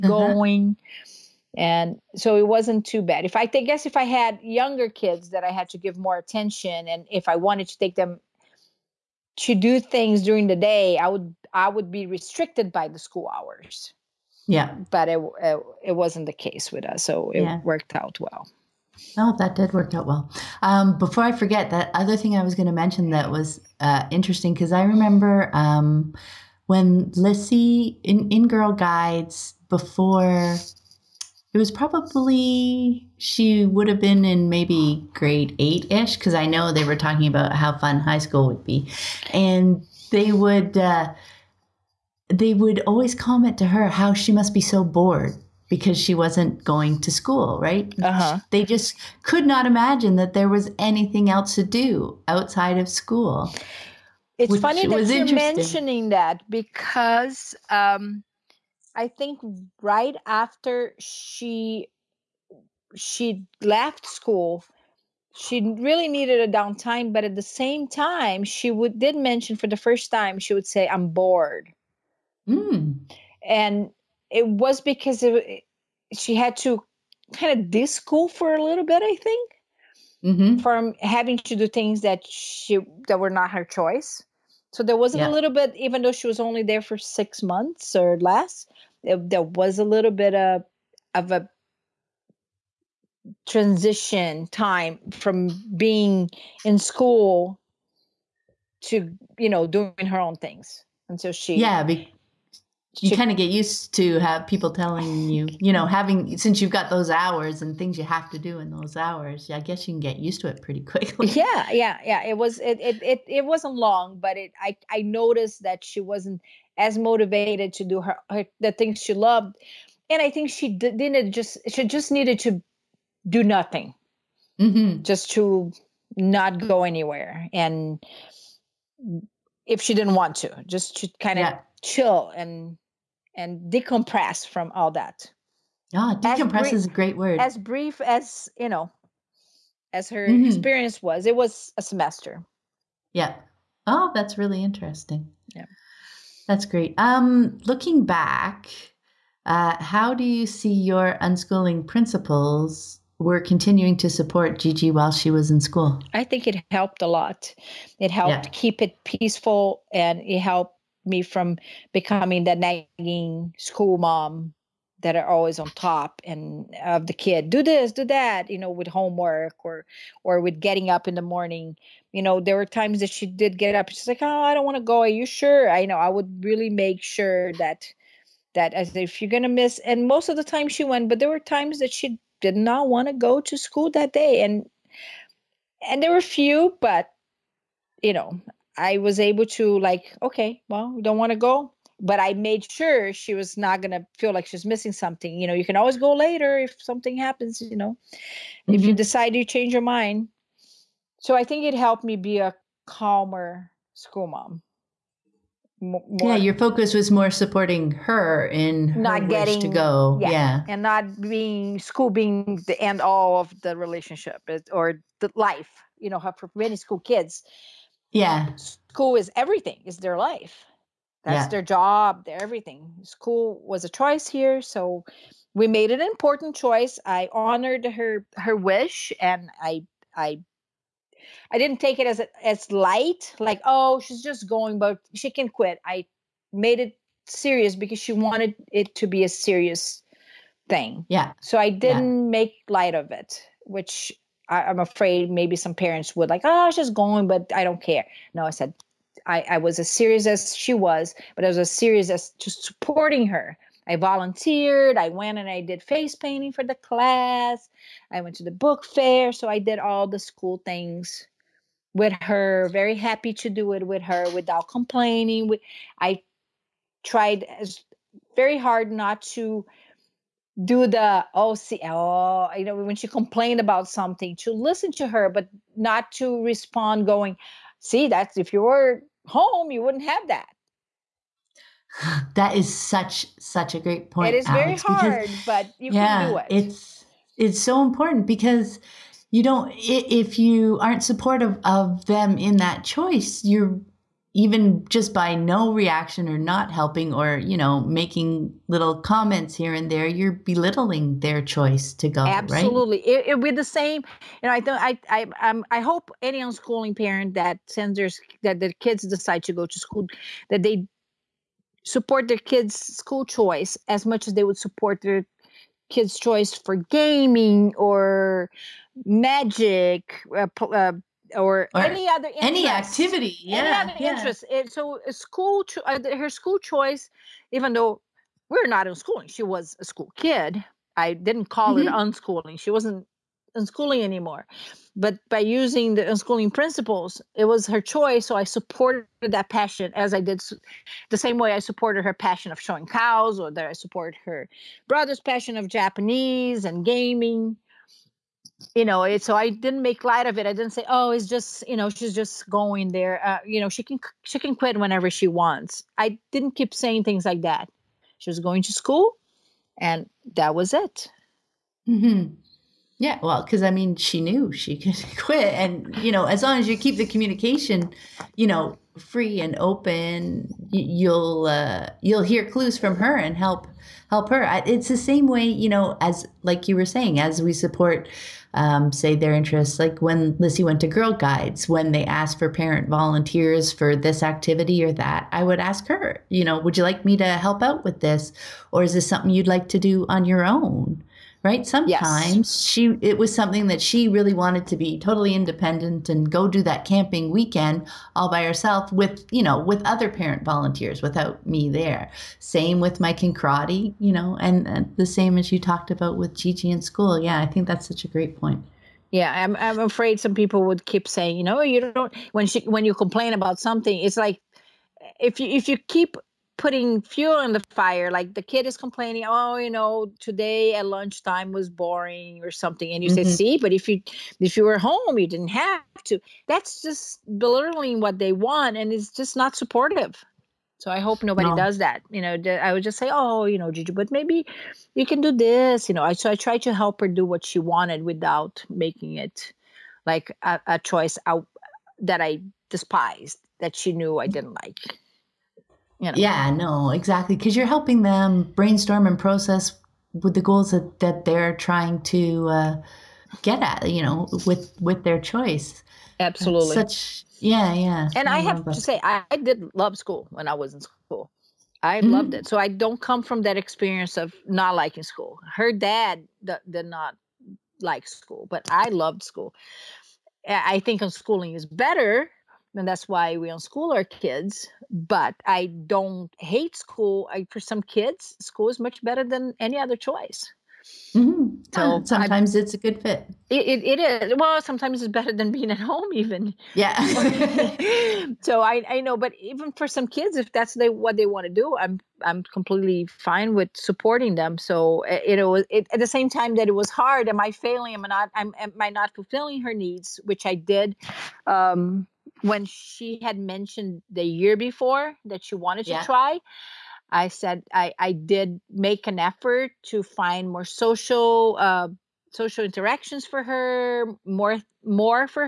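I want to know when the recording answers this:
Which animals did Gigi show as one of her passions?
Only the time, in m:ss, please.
5:42.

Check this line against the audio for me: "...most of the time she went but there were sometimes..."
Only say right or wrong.
wrong.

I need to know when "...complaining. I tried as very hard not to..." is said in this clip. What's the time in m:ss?
4:24.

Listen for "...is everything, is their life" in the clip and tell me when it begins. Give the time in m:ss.
3:39.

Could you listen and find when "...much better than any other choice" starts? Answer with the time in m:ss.
7:58.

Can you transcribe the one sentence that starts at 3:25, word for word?
More, yeah, your focus was more supporting her in not her getting to go.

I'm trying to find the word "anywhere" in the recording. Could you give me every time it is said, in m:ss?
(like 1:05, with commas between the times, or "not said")
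2:06.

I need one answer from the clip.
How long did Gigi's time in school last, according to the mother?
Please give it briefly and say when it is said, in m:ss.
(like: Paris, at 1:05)
a semester, at 2:21.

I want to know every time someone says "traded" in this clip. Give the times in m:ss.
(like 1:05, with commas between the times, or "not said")
not said.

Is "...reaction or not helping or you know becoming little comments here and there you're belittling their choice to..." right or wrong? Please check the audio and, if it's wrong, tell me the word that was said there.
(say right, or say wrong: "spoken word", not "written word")
wrong: "making", not "becoming".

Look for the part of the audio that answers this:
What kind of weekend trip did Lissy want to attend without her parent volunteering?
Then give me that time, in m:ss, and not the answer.
6:36.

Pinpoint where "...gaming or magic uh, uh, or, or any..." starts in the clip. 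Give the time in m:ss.
5:16.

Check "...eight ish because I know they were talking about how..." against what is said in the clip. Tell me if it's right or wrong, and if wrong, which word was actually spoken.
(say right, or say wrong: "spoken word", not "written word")
right.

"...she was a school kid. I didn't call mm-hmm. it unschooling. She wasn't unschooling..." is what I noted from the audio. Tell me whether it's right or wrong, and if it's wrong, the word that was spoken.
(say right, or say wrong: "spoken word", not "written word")
right.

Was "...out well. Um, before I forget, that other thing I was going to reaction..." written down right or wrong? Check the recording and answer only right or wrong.
wrong.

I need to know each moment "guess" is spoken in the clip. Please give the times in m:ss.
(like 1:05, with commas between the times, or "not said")
0:03, 1:49.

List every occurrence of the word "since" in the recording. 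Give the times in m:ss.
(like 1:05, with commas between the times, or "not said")
1:46.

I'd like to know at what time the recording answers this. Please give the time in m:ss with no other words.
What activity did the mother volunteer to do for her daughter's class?
4:15.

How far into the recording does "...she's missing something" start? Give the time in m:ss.
3:14.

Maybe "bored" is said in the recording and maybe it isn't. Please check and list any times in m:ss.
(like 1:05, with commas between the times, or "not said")
0:44, 1:11.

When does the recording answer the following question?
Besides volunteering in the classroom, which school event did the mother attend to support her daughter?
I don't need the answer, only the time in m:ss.
4:18.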